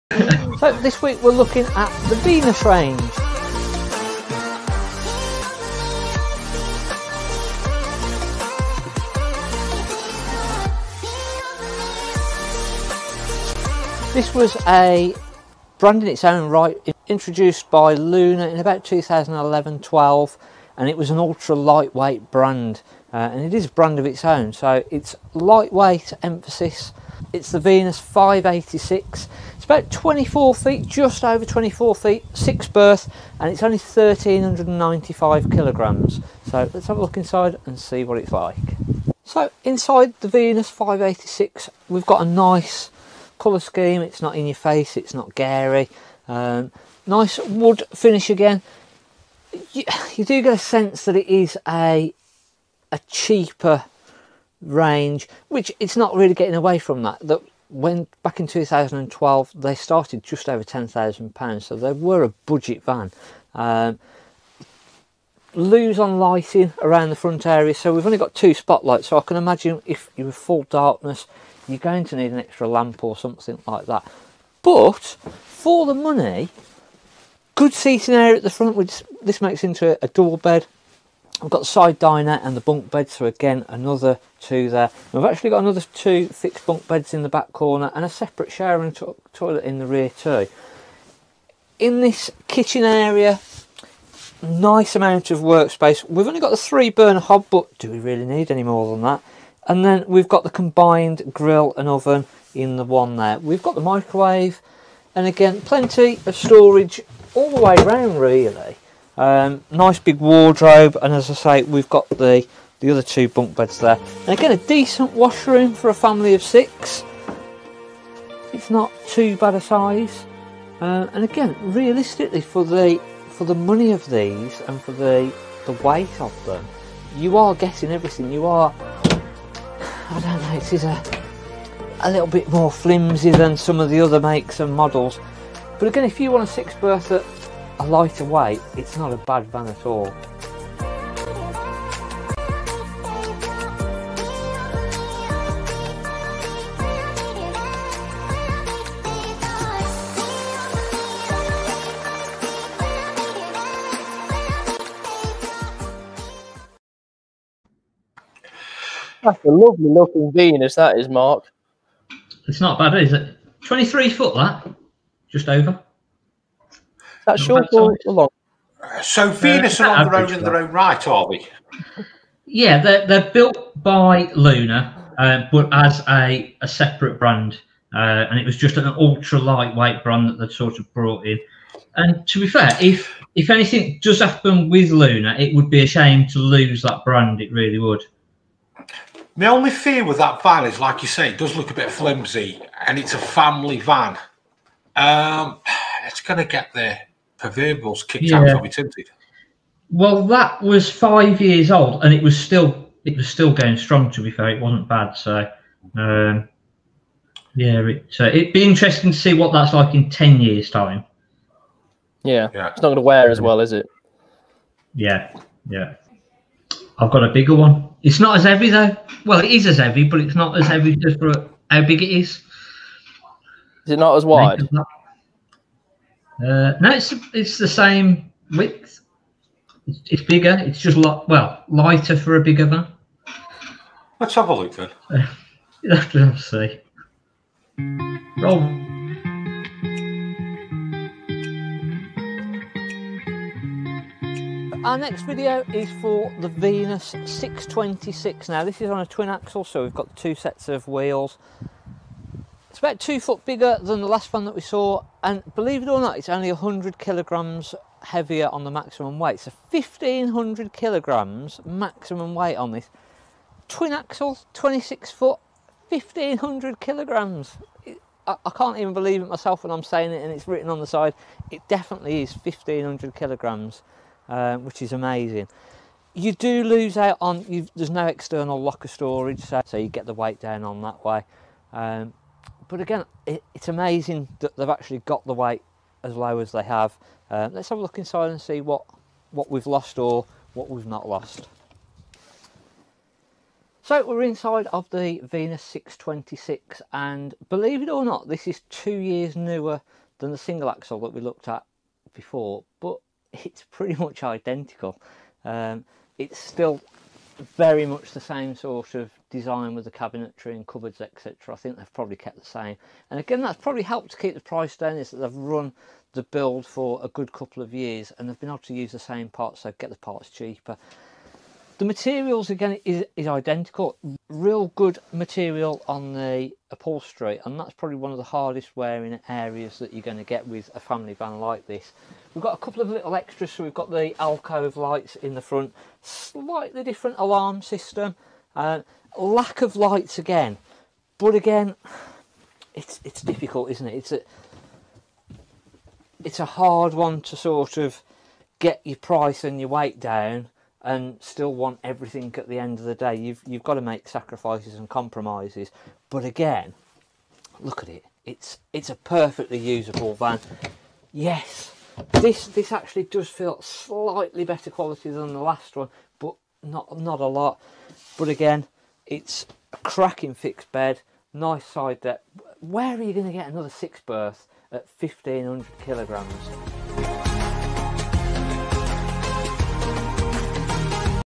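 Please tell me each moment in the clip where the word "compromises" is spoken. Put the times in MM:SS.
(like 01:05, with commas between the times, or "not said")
05:54.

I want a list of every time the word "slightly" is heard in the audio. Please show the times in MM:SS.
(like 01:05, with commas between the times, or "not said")
05:36, 06:03.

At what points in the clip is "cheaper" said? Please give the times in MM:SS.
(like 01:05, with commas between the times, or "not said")
00:53, 05:20.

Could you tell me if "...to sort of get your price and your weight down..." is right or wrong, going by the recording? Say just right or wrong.
right.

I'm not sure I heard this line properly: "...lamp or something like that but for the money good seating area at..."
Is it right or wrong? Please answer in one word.
right.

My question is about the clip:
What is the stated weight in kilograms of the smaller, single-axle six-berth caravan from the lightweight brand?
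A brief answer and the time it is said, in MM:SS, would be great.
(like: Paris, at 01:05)
1395, at 00:33.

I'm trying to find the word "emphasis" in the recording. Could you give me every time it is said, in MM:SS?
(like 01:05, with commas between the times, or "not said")
00:26.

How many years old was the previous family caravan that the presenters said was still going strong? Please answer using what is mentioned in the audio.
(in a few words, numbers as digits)
5.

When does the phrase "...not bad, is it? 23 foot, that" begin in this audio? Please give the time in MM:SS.
02:42.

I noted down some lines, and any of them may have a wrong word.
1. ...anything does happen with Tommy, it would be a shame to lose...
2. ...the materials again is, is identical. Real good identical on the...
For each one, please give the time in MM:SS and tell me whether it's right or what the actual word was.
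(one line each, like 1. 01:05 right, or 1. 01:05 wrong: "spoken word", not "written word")
1. 03:03 wrong: "Lunar", not "Tommy"
2. 05:21 wrong: "material", not "identical".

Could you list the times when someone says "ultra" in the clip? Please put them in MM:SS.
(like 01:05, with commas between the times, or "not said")
00:21, 02:58.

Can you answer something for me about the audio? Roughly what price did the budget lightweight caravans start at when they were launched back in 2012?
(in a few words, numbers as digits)
just over £10,000.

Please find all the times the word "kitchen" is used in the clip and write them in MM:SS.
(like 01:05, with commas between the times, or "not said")
01:32.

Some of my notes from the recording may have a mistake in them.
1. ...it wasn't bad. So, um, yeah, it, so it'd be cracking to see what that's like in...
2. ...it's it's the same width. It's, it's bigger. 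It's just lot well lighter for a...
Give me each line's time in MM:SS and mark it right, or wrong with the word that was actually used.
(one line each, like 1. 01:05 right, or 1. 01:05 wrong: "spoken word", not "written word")
1. 03:24 wrong: "interesting", not "cracking"
2. 03:46 right.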